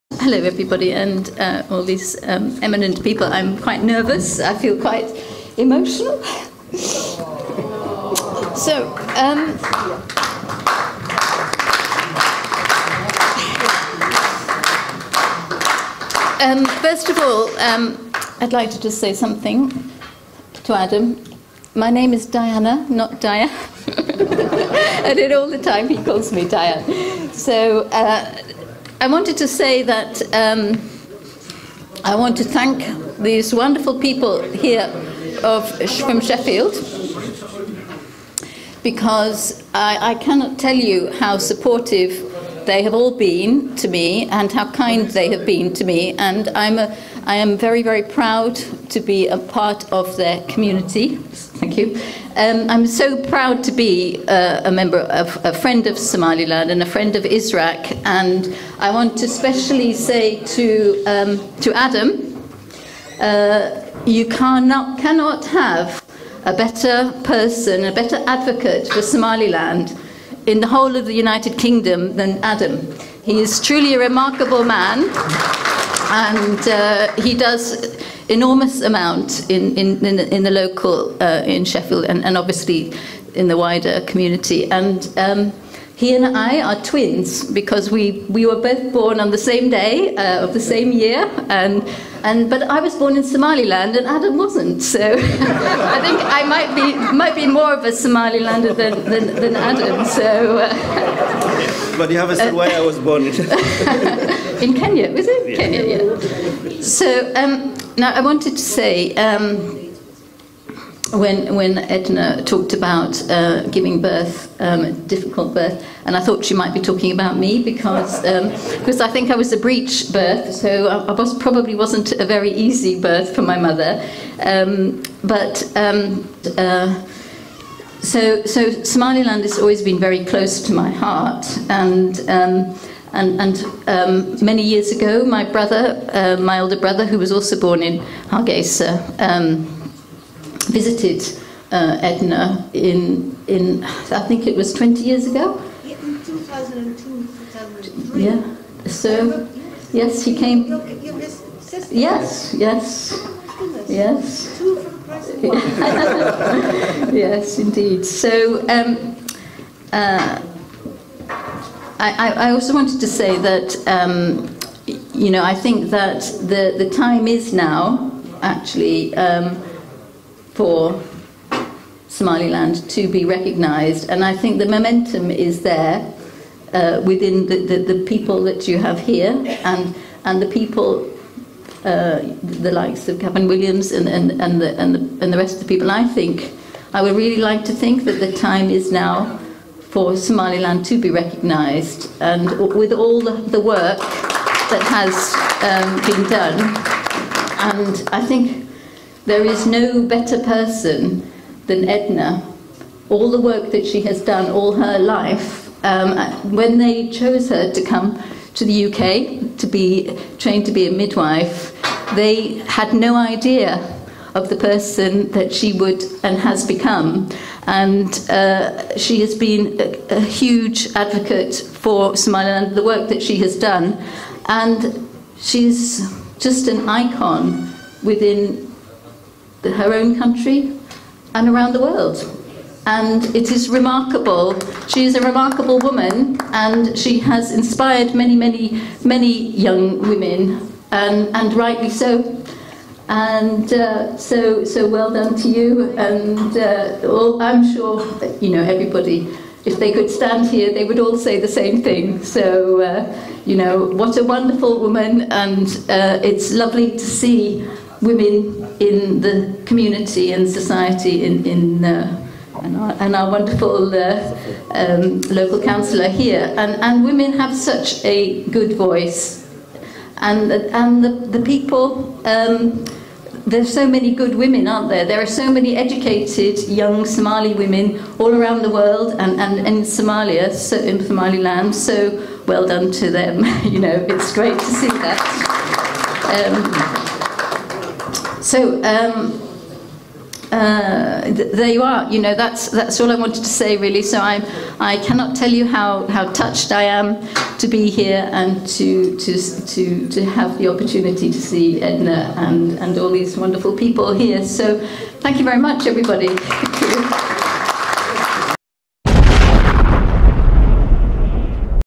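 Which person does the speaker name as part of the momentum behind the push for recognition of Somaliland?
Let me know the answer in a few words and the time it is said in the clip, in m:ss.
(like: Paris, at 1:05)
Kevin Williams, at 3:03.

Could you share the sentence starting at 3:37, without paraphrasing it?
And uh, she has been a, a huge advocate for and the work that she has done.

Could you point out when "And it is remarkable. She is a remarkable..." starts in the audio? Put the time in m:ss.
3:52.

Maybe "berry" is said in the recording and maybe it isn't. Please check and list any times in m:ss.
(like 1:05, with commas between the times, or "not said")
not said.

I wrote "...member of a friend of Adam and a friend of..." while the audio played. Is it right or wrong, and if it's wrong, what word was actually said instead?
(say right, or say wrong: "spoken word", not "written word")
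wrong: "Somaliland", not "Adam".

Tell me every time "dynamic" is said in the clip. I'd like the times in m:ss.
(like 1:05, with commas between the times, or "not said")
not said.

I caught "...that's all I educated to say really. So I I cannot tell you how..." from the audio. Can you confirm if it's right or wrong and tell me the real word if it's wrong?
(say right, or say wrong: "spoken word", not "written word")
wrong: "wanted", not "educated".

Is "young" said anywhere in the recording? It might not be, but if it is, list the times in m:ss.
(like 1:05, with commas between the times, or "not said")
3:59, 4:36.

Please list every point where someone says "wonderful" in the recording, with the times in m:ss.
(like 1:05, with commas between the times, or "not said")
0:33, 4:14, 4:23, 5:03.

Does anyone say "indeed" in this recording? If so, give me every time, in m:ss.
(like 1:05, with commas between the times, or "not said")
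2:37.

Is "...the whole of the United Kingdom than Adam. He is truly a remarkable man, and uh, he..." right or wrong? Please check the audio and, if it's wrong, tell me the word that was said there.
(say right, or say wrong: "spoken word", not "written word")
right.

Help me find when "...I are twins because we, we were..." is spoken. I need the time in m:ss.
1:26.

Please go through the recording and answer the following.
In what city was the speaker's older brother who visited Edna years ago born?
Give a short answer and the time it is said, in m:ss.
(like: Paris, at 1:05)
Hargeisa, at 2:18.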